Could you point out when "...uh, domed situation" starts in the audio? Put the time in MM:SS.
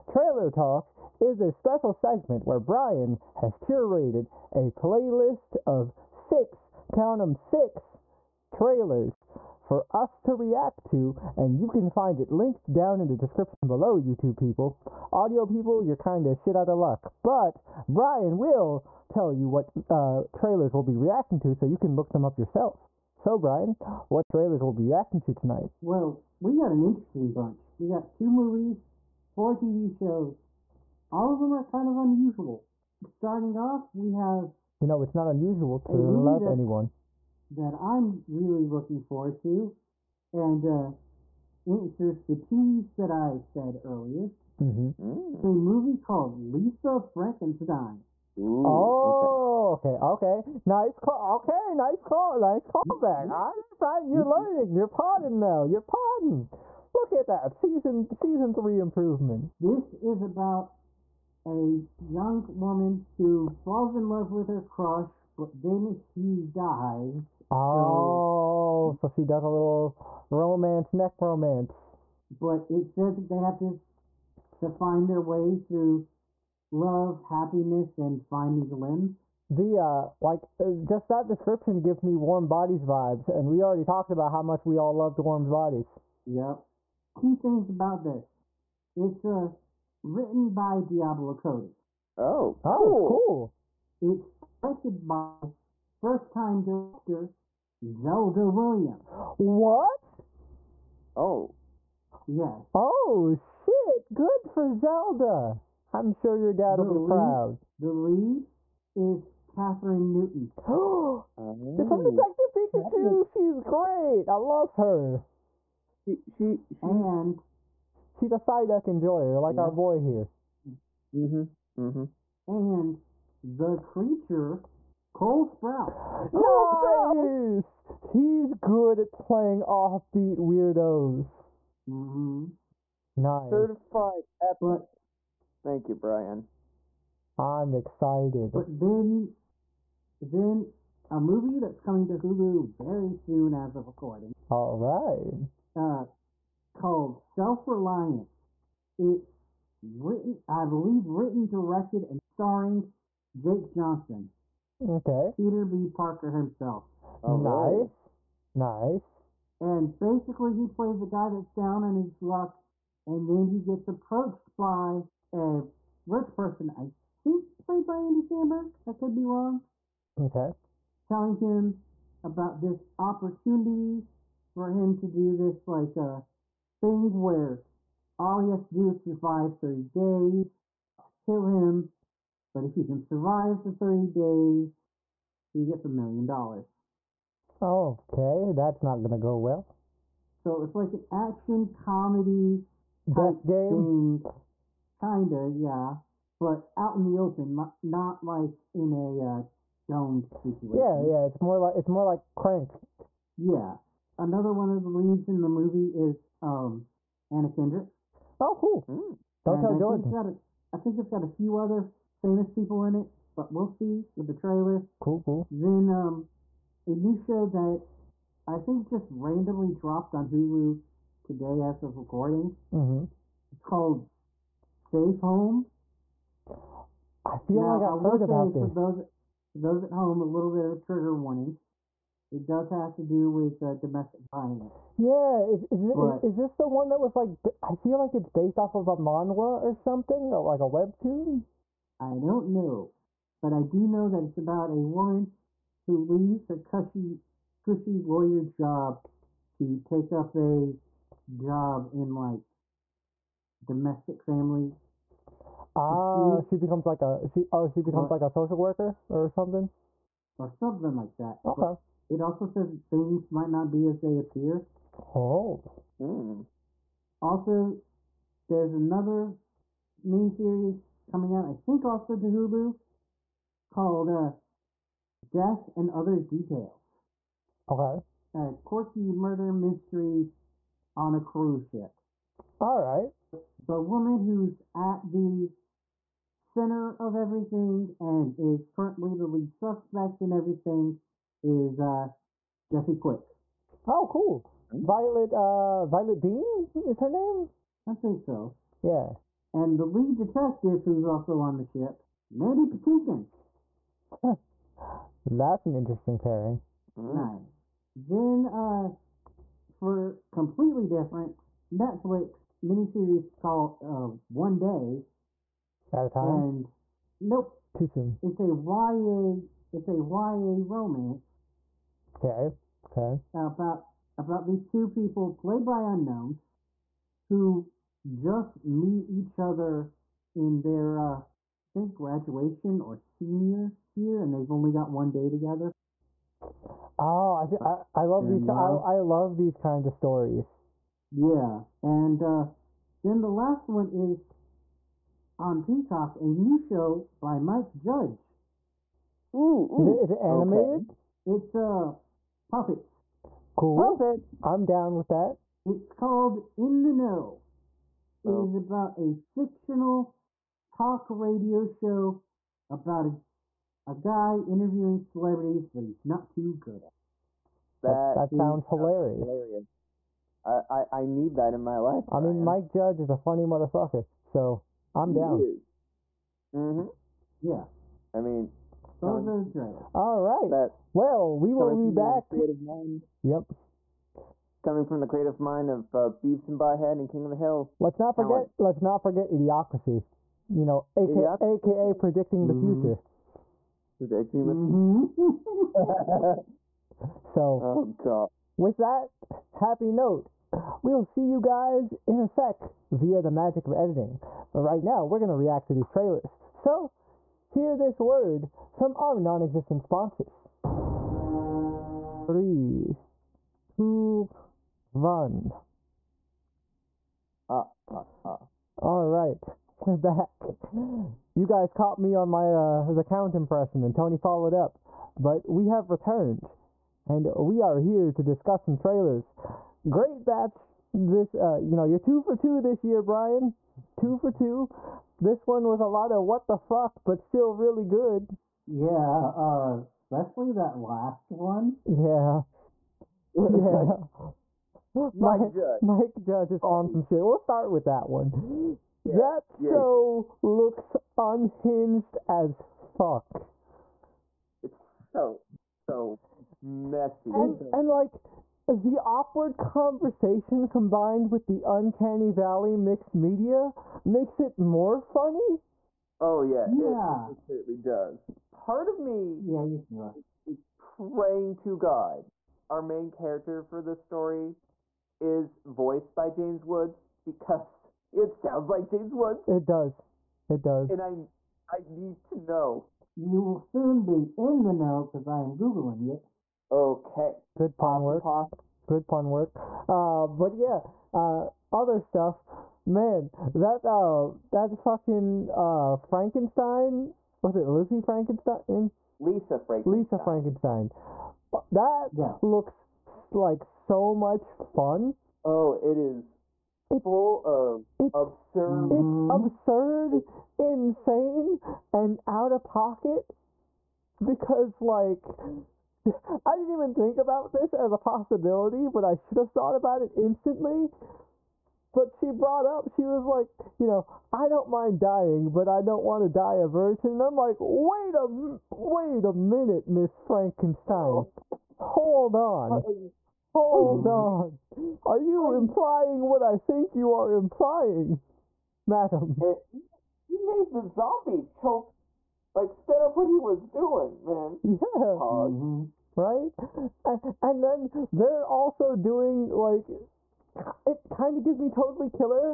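03:19.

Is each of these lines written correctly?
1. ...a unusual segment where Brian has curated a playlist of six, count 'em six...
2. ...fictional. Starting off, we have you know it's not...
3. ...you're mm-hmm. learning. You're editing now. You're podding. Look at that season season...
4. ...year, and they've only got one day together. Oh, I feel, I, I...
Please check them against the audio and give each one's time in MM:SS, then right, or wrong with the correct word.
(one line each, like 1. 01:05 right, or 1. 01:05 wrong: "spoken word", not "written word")
1. 00:01 wrong: "special", not "unusual"
2. 00:31 wrong: "unusual", not "fictional"
3. 00:54 wrong: "podding", not "editing"
4. 05:33 right.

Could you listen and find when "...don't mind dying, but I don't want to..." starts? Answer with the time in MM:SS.
08:44.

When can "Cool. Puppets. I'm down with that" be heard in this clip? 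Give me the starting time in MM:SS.
05:53.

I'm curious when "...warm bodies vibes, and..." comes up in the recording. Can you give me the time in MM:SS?
01:22.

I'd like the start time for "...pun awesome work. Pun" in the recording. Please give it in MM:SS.
08:07.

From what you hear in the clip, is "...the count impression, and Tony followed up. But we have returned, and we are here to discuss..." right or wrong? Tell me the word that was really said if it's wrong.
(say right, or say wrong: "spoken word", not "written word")
right.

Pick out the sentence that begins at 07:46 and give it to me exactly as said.
Oh yeah, yeah, it certainly does.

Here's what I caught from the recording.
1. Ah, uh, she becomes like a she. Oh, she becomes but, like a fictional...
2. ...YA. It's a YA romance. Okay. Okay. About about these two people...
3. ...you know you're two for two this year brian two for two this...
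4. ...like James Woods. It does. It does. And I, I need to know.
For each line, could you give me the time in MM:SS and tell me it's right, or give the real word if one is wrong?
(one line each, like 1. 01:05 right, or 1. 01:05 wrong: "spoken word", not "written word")
1. 04:15 wrong: "social", not "fictional"
2. 05:18 right
3. 07:11 right
4. 07:58 right.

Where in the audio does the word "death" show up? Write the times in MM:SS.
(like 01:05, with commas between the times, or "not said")
03:13, 04:35.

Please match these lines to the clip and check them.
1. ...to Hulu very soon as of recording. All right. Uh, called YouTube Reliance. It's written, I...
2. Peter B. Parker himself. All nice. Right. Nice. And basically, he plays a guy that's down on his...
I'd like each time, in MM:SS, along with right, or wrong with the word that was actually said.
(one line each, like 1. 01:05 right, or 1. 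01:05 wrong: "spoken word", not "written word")
1. 02:22 wrong: "Self", not "YouTube"
2. 02:35 right.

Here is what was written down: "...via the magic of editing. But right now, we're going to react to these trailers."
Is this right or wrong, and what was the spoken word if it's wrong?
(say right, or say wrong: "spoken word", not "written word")
right.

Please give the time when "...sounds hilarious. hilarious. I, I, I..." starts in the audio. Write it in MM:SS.
06:08.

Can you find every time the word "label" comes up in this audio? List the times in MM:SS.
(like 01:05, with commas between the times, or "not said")
not said.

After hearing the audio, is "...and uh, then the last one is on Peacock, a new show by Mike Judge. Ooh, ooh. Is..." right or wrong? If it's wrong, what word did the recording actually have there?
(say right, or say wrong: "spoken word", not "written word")
right.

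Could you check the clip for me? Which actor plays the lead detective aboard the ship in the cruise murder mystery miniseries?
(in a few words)
Mandy Patinkin.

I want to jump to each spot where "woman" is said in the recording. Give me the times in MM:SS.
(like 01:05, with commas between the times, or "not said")
01:02, 04:04, 04:43.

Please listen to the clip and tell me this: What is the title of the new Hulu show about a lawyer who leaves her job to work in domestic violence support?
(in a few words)
Safe Home.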